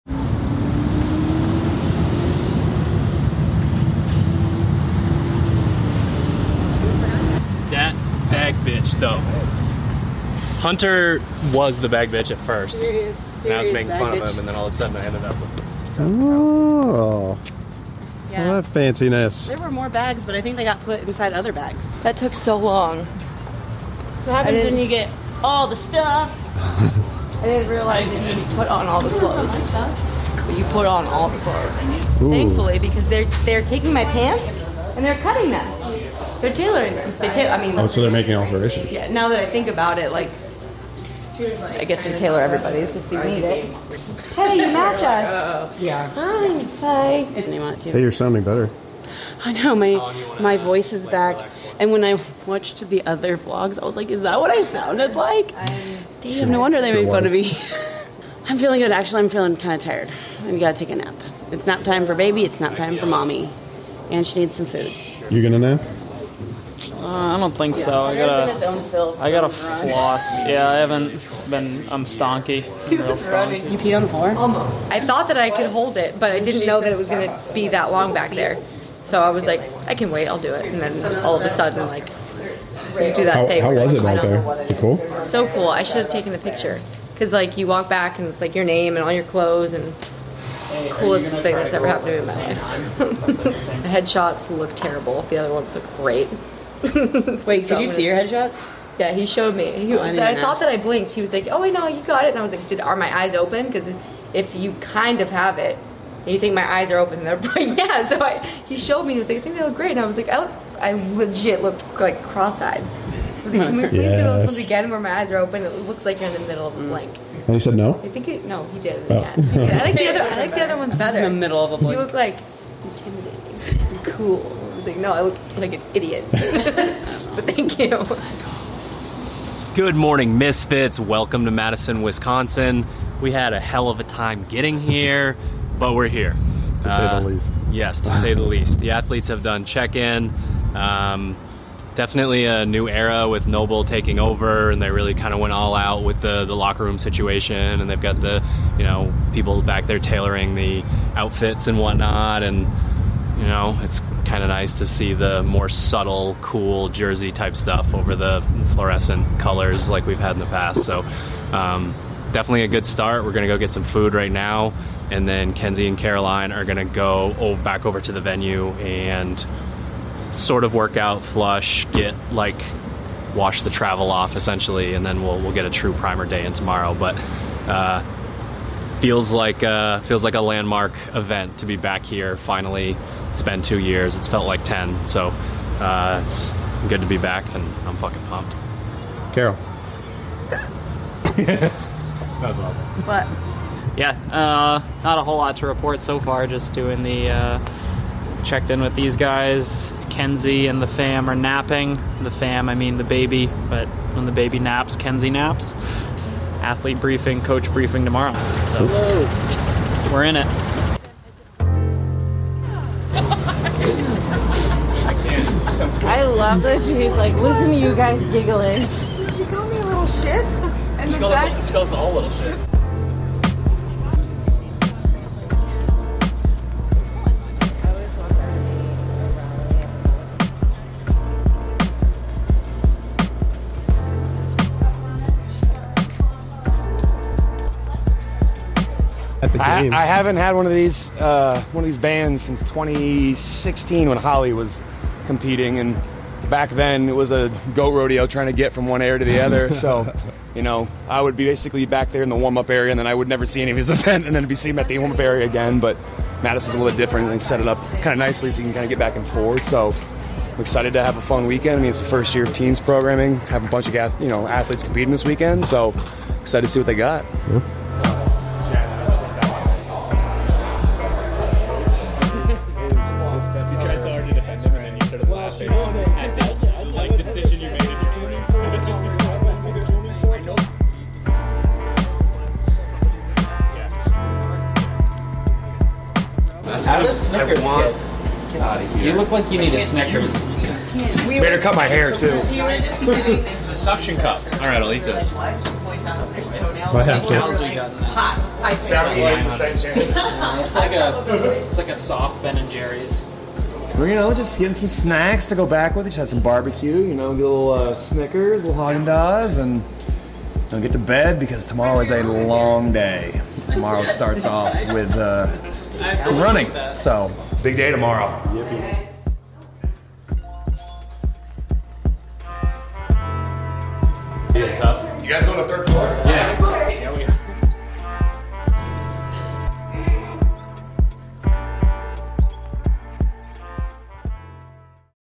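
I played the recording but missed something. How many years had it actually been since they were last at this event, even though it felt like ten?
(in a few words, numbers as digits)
2.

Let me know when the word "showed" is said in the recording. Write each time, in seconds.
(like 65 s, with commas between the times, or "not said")
99 s, 108 s.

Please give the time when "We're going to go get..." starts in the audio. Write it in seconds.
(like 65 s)
163 s.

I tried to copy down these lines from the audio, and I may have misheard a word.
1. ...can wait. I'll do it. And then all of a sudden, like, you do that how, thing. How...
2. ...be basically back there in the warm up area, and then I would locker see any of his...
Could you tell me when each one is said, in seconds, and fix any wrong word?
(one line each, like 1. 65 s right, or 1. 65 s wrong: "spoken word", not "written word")
1. 79 s right
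2. 251 s wrong: "never", not "locker".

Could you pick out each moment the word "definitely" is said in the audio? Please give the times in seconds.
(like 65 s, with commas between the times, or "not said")
141 s, 162 s.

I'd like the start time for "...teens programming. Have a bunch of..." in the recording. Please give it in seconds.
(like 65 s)
262 s.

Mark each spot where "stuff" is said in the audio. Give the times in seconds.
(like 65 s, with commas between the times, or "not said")
25 s, 157 s.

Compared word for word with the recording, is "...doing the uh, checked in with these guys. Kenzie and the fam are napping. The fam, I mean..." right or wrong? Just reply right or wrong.
right.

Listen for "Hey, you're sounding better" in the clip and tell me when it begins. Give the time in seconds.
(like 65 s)
47 s.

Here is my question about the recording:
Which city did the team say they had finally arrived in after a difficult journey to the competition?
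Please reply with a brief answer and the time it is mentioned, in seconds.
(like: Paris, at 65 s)
Madison, Wisconsin, at 131 s.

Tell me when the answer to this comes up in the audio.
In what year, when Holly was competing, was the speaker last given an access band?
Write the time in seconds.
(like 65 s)
242 s.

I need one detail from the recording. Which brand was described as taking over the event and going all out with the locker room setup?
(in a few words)
NOBULL.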